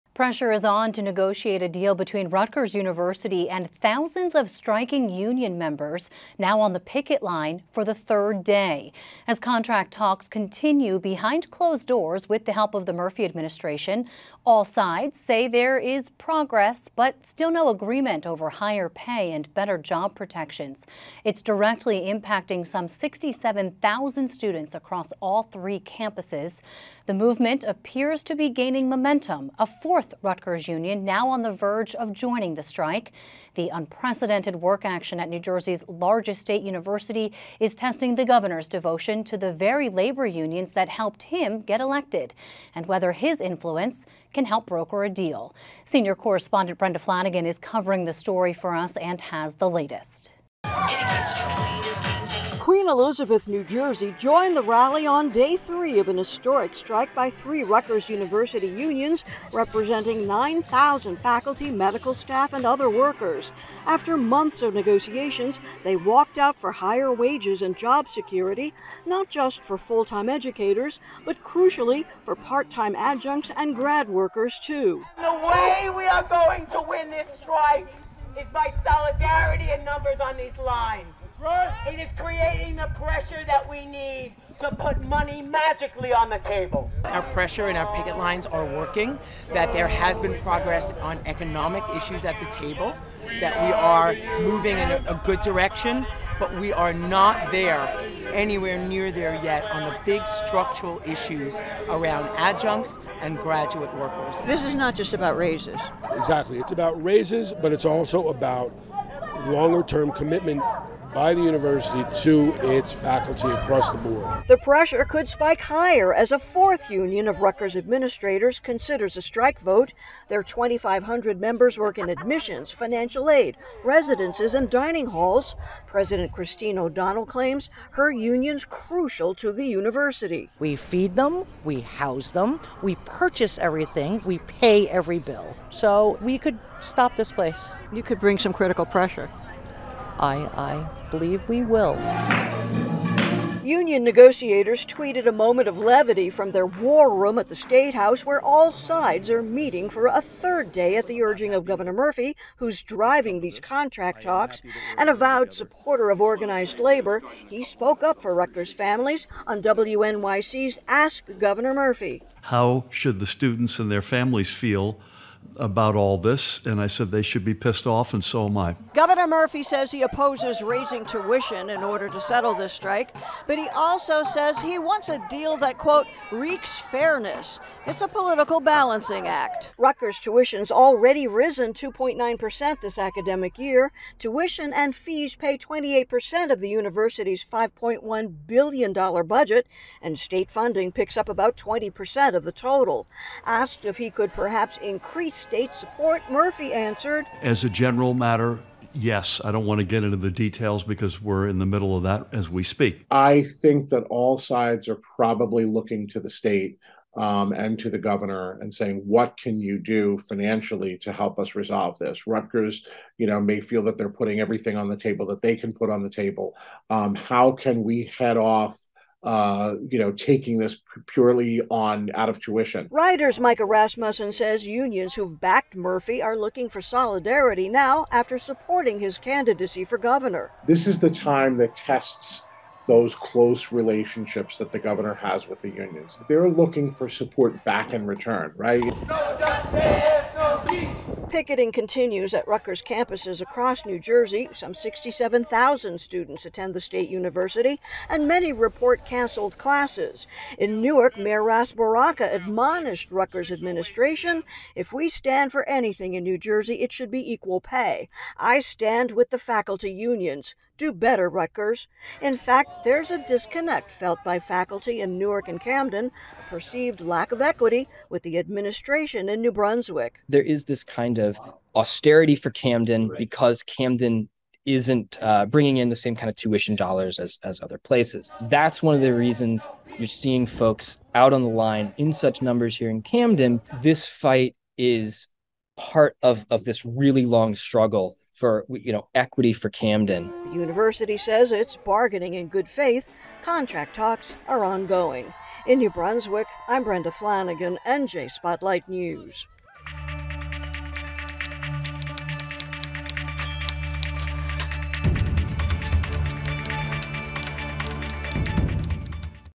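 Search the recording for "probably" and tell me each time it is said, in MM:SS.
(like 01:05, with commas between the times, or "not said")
03:25.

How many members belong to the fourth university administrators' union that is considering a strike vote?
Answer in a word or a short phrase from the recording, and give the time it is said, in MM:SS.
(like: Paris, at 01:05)
2,500, at 02:00.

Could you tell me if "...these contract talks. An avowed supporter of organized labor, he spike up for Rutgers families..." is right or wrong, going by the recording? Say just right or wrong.
wrong.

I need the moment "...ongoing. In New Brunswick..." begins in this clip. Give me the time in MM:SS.
04:54.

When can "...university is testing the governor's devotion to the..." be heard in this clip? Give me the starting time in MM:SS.
00:36.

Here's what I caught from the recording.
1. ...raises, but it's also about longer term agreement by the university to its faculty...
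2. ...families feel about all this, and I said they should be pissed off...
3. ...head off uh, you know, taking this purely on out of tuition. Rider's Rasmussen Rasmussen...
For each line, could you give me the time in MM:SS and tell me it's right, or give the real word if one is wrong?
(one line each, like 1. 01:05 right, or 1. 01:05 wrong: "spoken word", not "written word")
1. 01:47 wrong: "commitment", not "agreement"
2. 02:44 right
3. 03:38 wrong: "Micah", not "Rasmussen".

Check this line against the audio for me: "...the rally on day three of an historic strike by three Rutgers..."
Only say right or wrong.
right.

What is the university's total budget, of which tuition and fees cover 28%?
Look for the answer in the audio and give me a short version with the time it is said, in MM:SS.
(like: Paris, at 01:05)
$5.1 billion, at 03:07.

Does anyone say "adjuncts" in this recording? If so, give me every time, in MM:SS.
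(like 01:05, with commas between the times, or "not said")
01:12, 01:42.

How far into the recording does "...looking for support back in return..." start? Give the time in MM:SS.
03:56.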